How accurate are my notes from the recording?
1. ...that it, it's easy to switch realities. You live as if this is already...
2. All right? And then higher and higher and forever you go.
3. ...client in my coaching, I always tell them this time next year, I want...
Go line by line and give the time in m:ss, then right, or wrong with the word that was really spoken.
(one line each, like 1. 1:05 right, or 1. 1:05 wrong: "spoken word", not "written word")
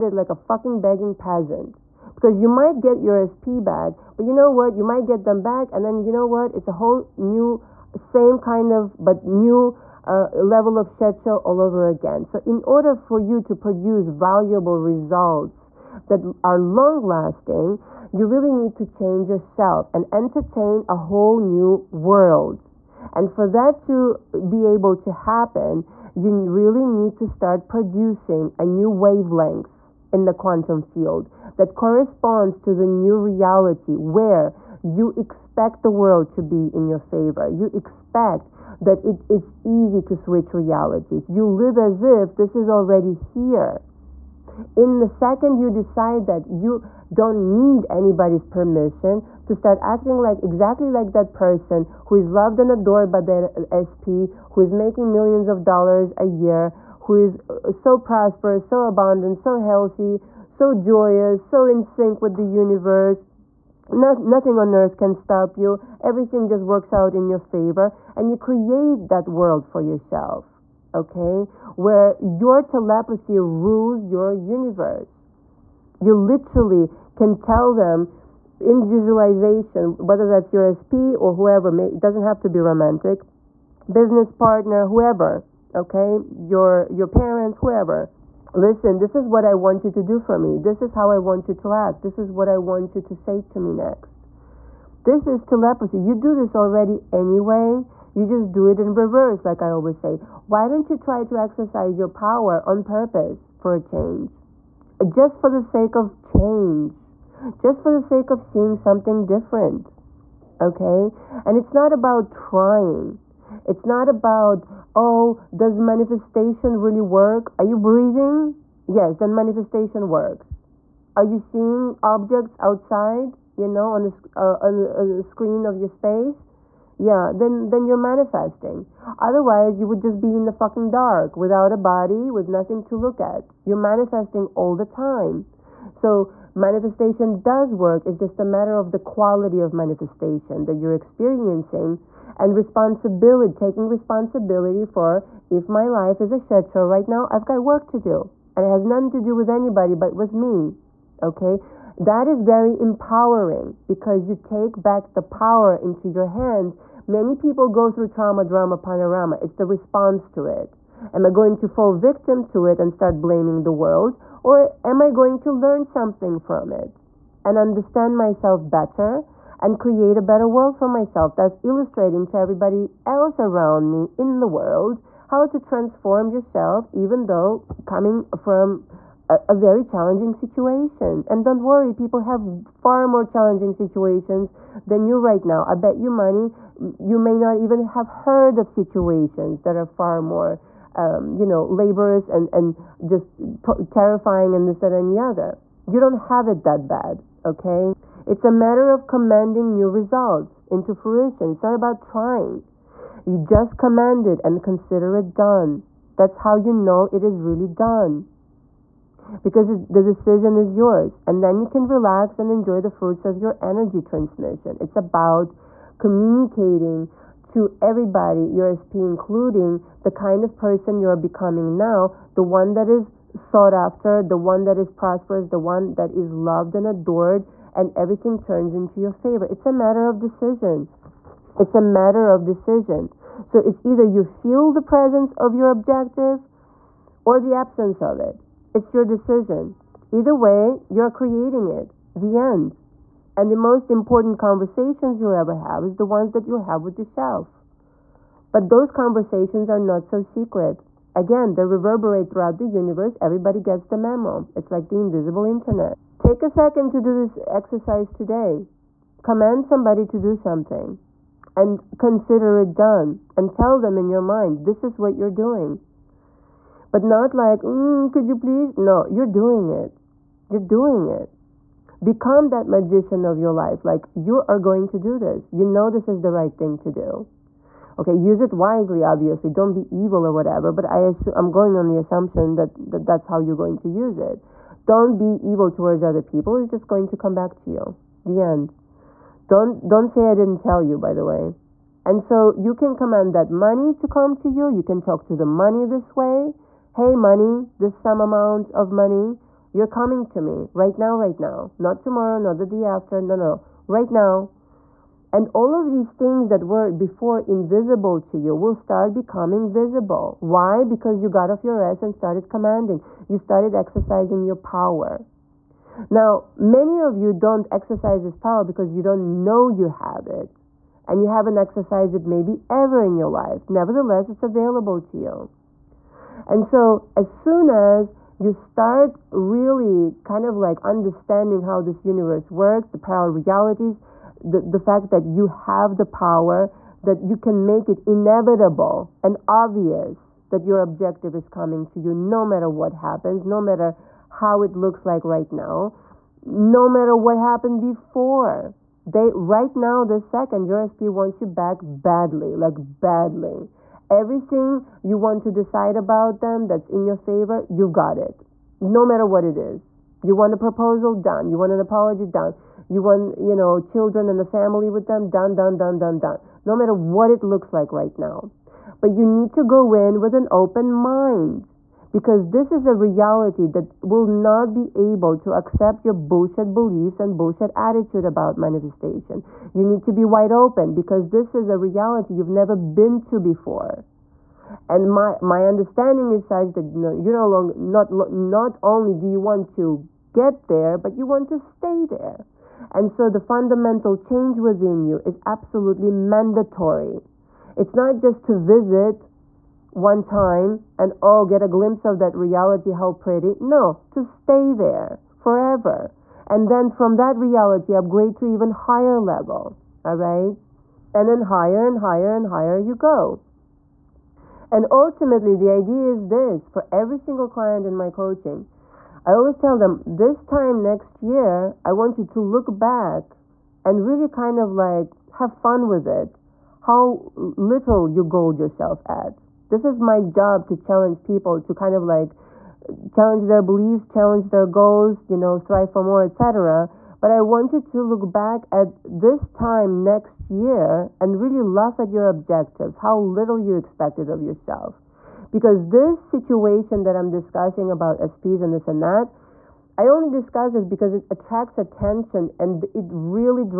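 1. 0:38 right
2. 6:50 wrong: "higher", not "forever"
3. 6:57 right.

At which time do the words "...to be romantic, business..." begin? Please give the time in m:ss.
1:22.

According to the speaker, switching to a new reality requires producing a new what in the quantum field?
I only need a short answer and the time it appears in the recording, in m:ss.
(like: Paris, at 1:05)
wavelength, at 0:28.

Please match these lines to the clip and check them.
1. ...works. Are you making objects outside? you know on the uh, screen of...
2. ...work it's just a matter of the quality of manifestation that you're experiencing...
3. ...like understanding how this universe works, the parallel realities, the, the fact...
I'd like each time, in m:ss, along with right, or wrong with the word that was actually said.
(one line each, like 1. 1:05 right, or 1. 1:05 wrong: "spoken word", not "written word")
1. 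2:00 wrong: "seeing", not "making"
2. 2:17 right
3. 5:30 right.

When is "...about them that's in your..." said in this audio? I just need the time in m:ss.
5:55.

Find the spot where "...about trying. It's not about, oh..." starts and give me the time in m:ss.
1:51.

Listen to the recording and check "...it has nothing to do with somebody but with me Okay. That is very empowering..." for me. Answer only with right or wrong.
wrong.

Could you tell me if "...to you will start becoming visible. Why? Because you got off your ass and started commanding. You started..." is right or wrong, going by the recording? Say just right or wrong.
right.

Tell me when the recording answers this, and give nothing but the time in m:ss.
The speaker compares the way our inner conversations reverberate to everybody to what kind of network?
4:14.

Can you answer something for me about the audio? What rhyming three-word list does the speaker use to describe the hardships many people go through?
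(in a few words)
trauma, drama, panorama.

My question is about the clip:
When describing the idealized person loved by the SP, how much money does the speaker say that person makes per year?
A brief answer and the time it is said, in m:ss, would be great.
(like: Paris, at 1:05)
millions of dollars, at 0:55.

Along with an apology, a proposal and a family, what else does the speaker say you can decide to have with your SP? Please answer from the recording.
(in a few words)
children.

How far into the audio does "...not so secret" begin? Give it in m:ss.
4:09.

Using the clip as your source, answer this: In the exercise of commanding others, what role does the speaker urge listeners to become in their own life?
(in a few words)
magician.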